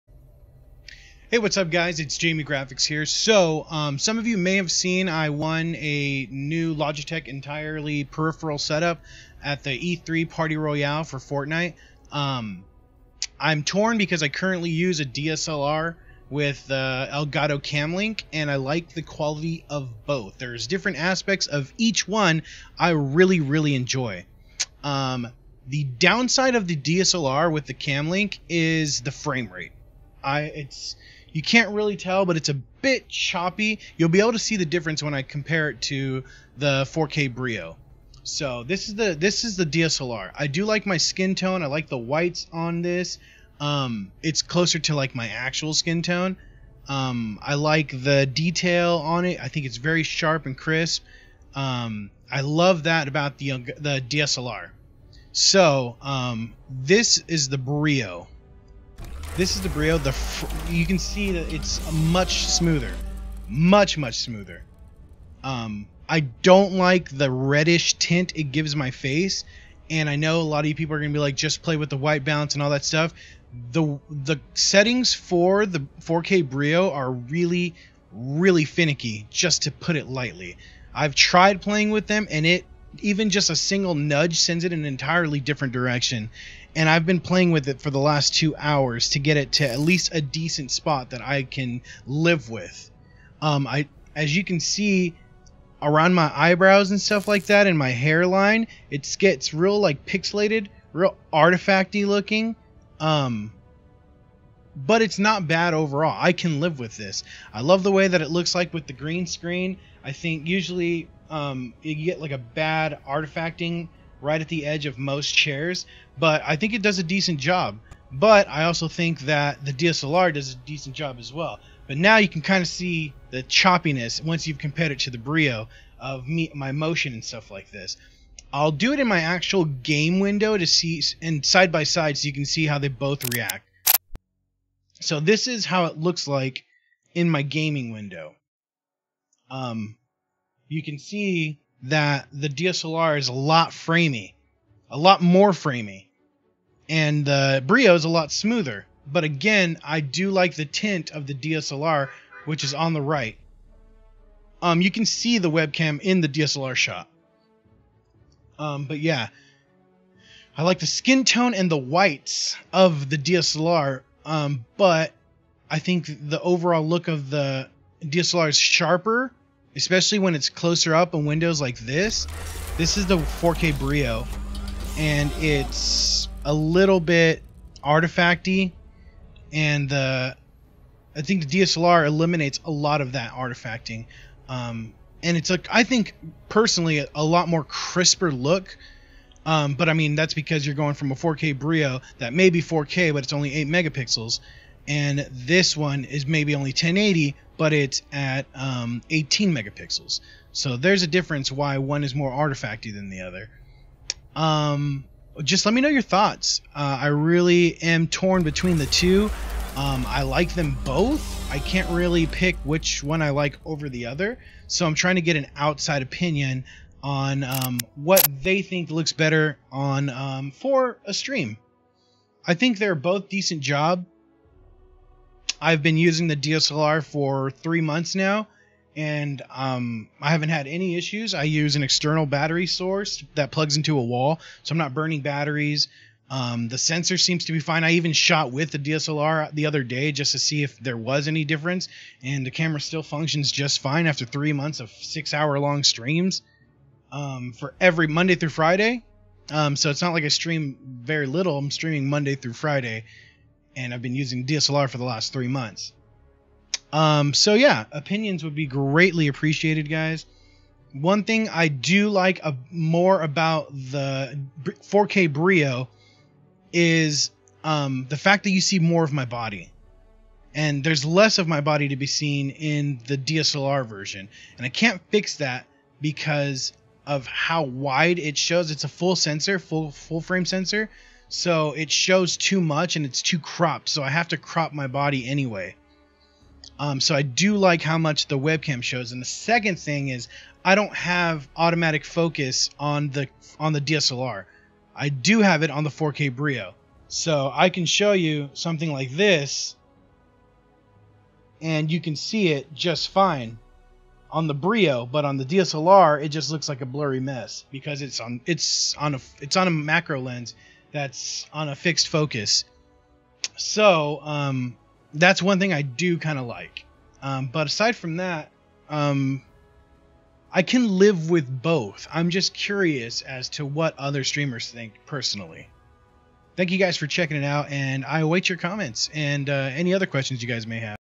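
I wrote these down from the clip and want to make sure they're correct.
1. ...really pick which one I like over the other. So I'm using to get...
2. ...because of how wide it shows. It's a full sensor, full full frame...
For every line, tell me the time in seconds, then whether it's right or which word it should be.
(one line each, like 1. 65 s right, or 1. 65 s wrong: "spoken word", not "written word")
1. 211 s wrong: "trying", not "using"
2. 276 s right.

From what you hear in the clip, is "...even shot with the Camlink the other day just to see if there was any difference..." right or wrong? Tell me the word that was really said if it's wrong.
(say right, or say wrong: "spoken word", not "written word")
wrong: "DSLR", not "Camlink".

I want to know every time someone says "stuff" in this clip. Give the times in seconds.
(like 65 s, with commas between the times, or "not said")
72 s, 97 s, 127 s.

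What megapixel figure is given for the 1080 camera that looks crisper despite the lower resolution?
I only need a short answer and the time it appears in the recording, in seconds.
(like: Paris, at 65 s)
18 megapixels, at 199 s.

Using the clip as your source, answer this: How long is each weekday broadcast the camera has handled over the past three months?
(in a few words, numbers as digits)
6 hours.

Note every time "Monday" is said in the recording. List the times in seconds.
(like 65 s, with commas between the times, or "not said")
248 s, 252 s.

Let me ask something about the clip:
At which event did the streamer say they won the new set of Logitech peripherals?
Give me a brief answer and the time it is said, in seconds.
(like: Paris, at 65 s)
E3 Party Royale, at 9 s.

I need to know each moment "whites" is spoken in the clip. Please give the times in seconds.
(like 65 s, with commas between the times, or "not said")
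41 s, 71 s, 161 s.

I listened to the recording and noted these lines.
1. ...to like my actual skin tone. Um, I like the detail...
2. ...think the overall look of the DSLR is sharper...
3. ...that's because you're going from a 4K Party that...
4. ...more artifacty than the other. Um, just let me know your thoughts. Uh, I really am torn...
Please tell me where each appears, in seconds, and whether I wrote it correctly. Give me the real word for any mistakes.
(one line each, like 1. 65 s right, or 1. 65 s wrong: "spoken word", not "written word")
1. 44 s right
2. 165 s right
3. 190 s wrong: "Brio", not "Party"
4. 202 s right.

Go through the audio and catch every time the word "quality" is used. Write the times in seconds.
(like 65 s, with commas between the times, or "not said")
19 s.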